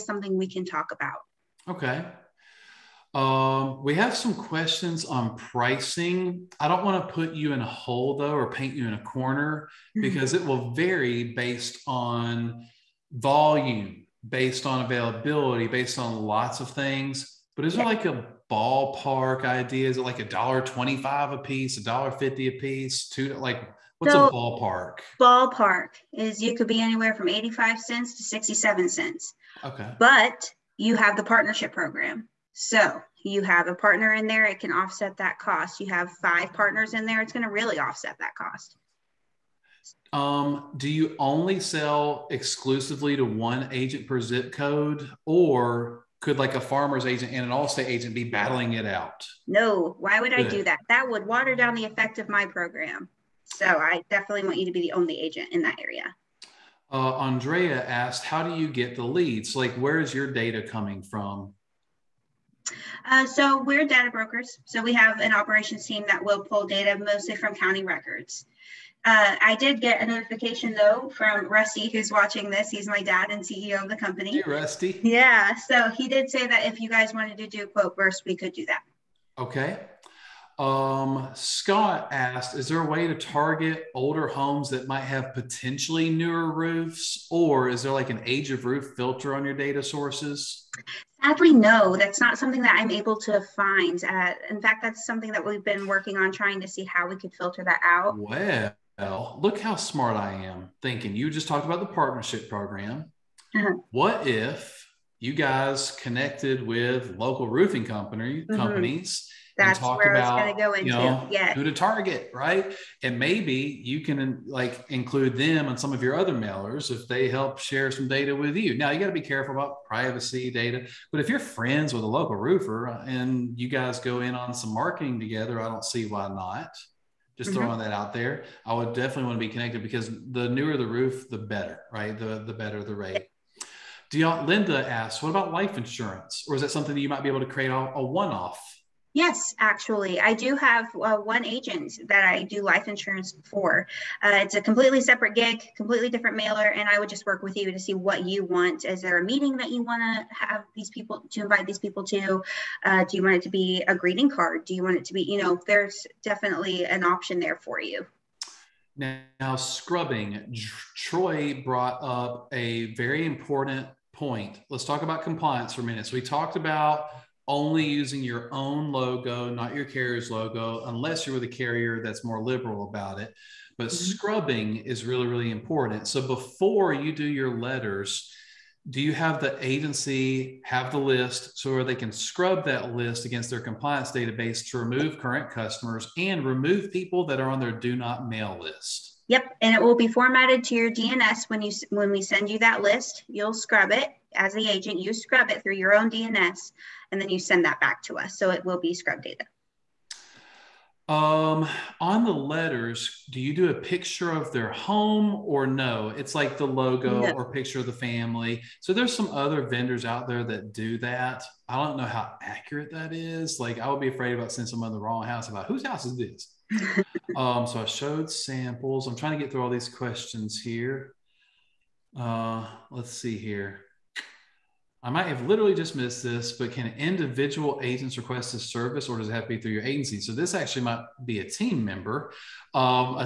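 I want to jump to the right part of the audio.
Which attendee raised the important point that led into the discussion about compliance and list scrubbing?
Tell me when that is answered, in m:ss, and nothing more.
2:40.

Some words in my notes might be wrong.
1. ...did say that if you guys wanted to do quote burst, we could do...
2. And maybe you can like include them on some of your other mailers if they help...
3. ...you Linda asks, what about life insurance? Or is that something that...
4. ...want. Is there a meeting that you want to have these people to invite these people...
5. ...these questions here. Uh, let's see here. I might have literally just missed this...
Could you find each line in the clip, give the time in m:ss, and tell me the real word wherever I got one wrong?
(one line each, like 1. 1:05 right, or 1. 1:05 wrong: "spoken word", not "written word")
1. 1:16 right
2. 1:53 right
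3. 2:14 right
4. 2:28 right
5. 3:39 right.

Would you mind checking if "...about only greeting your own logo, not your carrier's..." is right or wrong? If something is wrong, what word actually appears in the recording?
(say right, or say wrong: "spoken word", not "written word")
wrong: "using", not "greeting".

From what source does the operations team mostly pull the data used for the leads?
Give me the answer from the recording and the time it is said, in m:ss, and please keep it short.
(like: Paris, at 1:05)
county records, at 1:07.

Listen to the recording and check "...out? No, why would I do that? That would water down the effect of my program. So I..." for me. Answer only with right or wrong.
right.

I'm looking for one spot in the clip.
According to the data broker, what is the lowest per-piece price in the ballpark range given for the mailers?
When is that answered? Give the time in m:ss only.
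0:28.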